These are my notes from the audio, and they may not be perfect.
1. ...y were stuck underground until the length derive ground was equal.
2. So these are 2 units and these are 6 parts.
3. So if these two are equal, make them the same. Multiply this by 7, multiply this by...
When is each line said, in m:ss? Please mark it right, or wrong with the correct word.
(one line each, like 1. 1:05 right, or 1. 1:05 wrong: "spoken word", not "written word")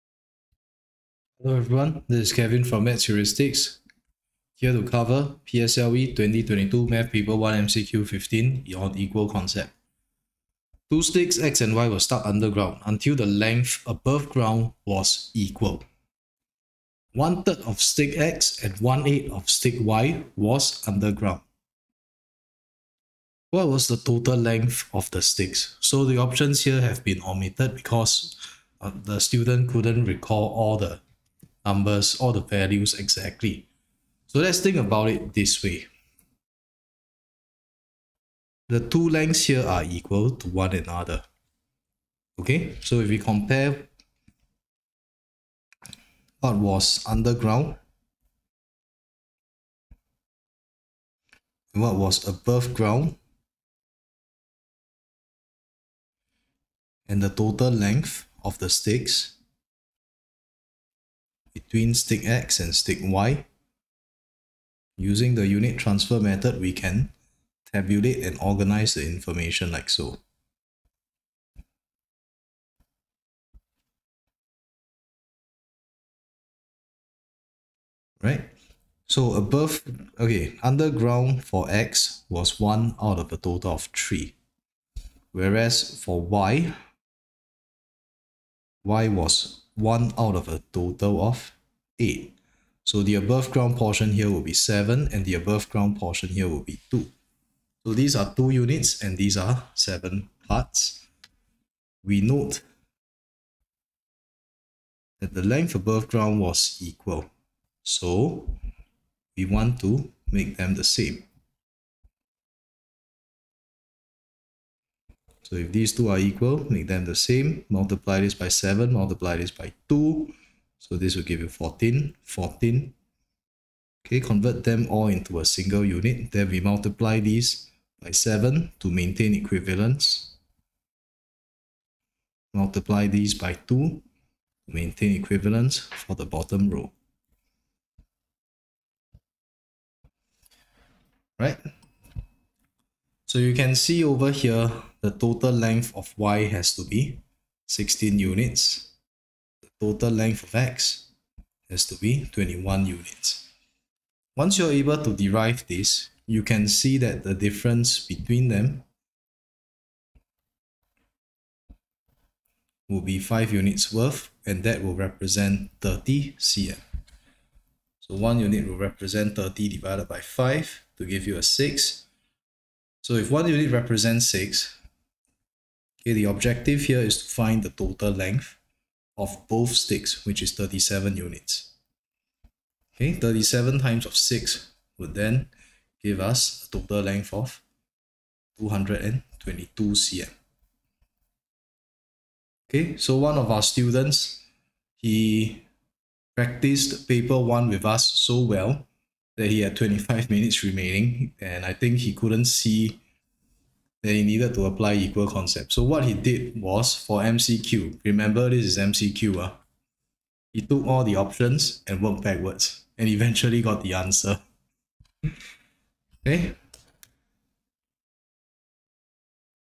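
1. 0:11 wrong: "above", not "derive"
2. 1:37 wrong: "7", not "6"
3. 1:55 right.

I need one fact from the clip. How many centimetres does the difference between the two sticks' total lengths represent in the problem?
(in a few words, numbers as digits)
30 cm.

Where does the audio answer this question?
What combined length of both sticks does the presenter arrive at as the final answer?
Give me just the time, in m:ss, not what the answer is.
3:08.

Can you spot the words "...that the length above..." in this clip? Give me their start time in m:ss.
1:45.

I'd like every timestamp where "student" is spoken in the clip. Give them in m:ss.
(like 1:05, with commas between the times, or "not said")
0:29, 3:13.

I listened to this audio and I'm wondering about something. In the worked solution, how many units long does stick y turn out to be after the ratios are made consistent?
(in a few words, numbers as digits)
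16 units.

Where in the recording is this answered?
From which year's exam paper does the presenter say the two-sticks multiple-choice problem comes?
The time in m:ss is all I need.
0:06.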